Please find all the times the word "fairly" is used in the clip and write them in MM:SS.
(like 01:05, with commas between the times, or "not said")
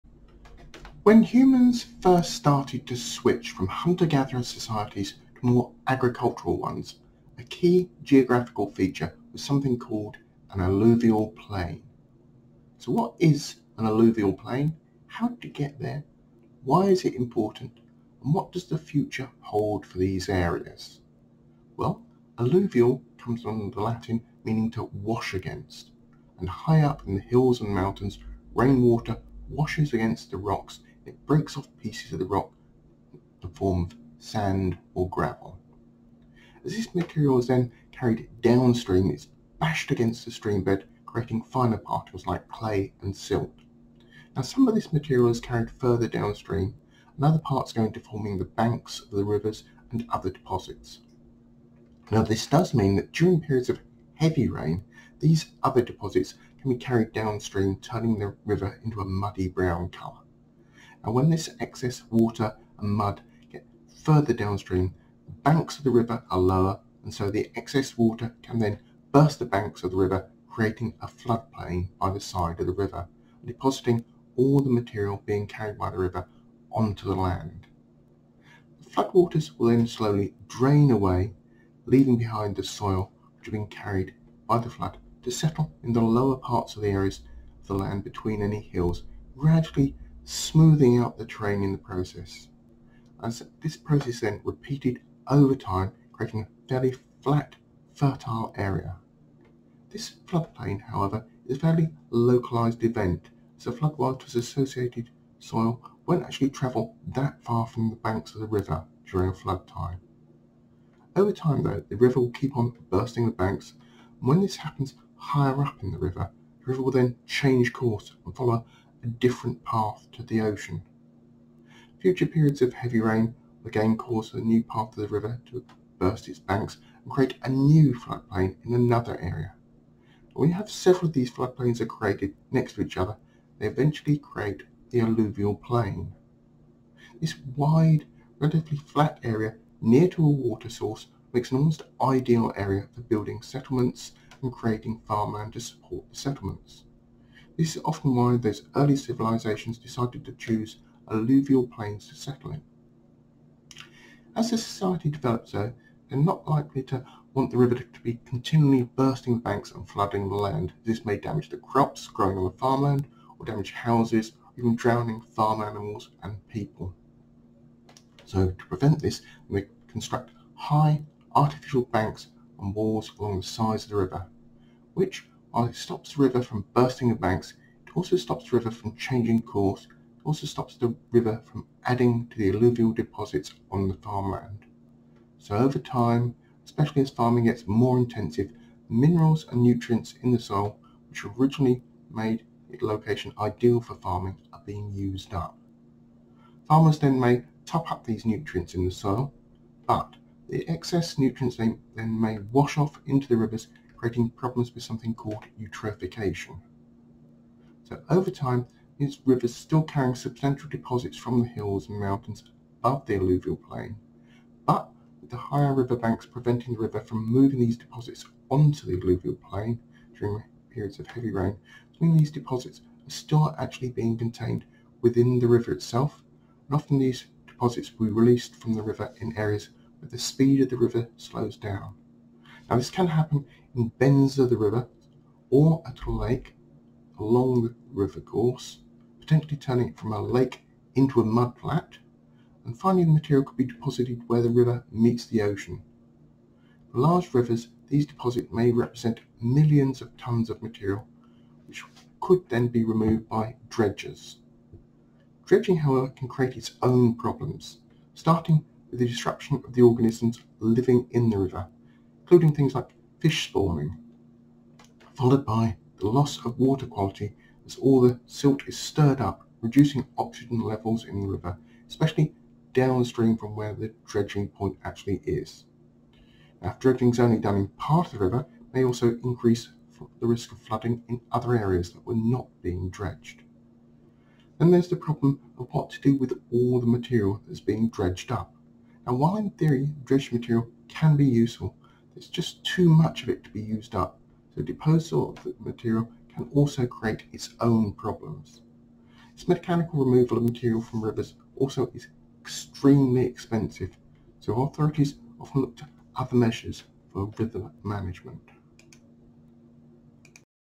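01:36, 01:41.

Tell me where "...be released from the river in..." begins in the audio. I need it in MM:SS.
03:48.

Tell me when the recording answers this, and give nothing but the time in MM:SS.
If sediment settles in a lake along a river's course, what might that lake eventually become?
04:01.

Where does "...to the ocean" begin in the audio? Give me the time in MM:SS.
02:00.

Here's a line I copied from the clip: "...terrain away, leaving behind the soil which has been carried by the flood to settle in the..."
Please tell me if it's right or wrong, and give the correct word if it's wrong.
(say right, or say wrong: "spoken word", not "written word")
wrong: "drain", not "terrain".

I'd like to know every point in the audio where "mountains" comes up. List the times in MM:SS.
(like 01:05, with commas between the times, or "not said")
00:27, 03:31.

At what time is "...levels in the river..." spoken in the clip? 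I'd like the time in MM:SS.
04:30.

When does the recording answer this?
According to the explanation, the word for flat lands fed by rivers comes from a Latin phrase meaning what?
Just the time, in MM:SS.
00:24.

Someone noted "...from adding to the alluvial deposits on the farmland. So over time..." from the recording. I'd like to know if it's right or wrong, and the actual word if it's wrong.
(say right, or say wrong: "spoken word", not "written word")
right.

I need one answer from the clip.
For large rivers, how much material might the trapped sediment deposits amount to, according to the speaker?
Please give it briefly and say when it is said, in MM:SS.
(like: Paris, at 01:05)
millions of tons, at 04:09.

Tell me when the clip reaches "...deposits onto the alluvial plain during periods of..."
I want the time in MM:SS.
03:37.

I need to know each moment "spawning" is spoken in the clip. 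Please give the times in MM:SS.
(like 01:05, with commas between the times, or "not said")
04:23.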